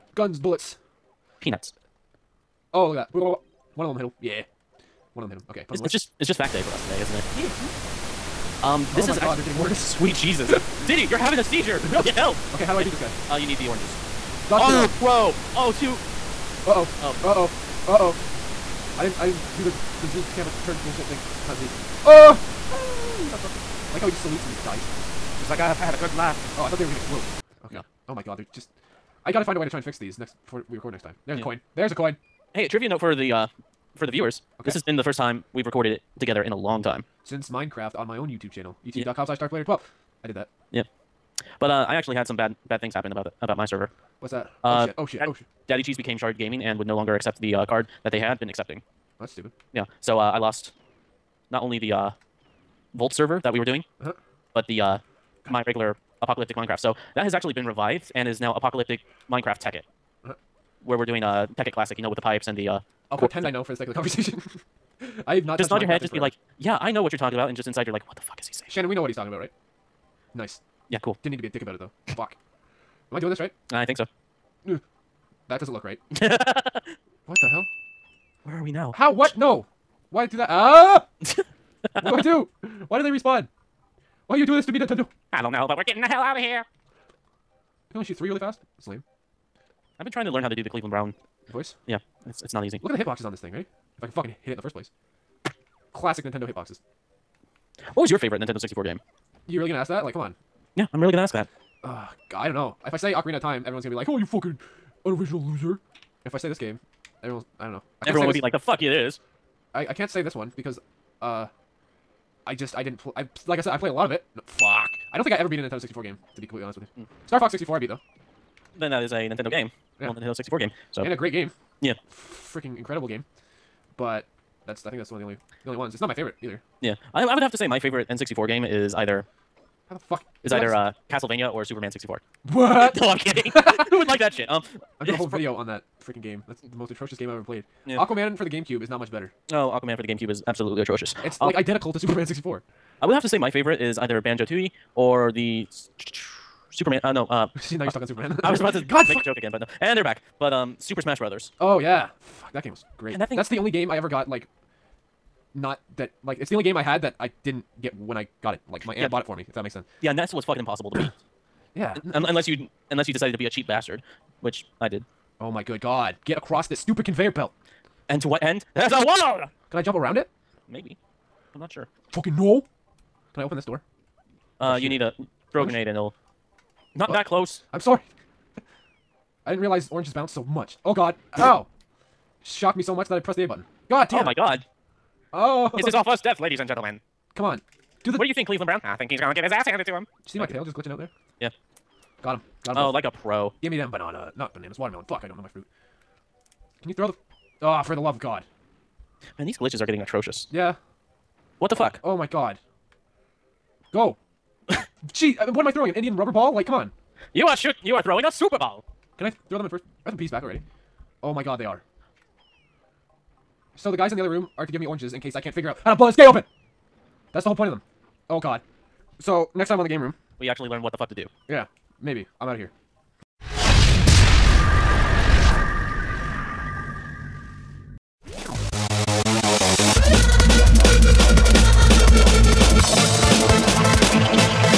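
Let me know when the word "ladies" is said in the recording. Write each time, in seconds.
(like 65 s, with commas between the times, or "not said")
186 s.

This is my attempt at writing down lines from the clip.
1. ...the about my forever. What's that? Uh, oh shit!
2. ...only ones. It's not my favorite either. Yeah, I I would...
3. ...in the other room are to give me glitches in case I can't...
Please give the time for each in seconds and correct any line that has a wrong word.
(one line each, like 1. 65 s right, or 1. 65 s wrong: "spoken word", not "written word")
1. 43 s wrong: "server", not "forever"
2. 125 s right
3. 214 s wrong: "oranges", not "glitches".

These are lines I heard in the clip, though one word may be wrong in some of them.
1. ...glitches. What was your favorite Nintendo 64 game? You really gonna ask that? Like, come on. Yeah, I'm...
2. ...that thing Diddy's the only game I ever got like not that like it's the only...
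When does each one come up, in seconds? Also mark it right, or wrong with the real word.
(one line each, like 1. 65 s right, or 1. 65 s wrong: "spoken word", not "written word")
1. 96 s wrong: "hitboxes", not "glitches"
2. 153 s wrong: "That", not "Diddy".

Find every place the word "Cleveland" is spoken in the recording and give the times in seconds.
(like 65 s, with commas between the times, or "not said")
90 s, 188 s.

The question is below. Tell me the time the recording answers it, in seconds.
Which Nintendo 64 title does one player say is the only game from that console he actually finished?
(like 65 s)
117 s.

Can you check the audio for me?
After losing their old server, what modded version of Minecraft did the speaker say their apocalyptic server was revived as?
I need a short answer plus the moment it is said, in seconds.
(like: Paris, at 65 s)
Tekkit Classic, at 61 s.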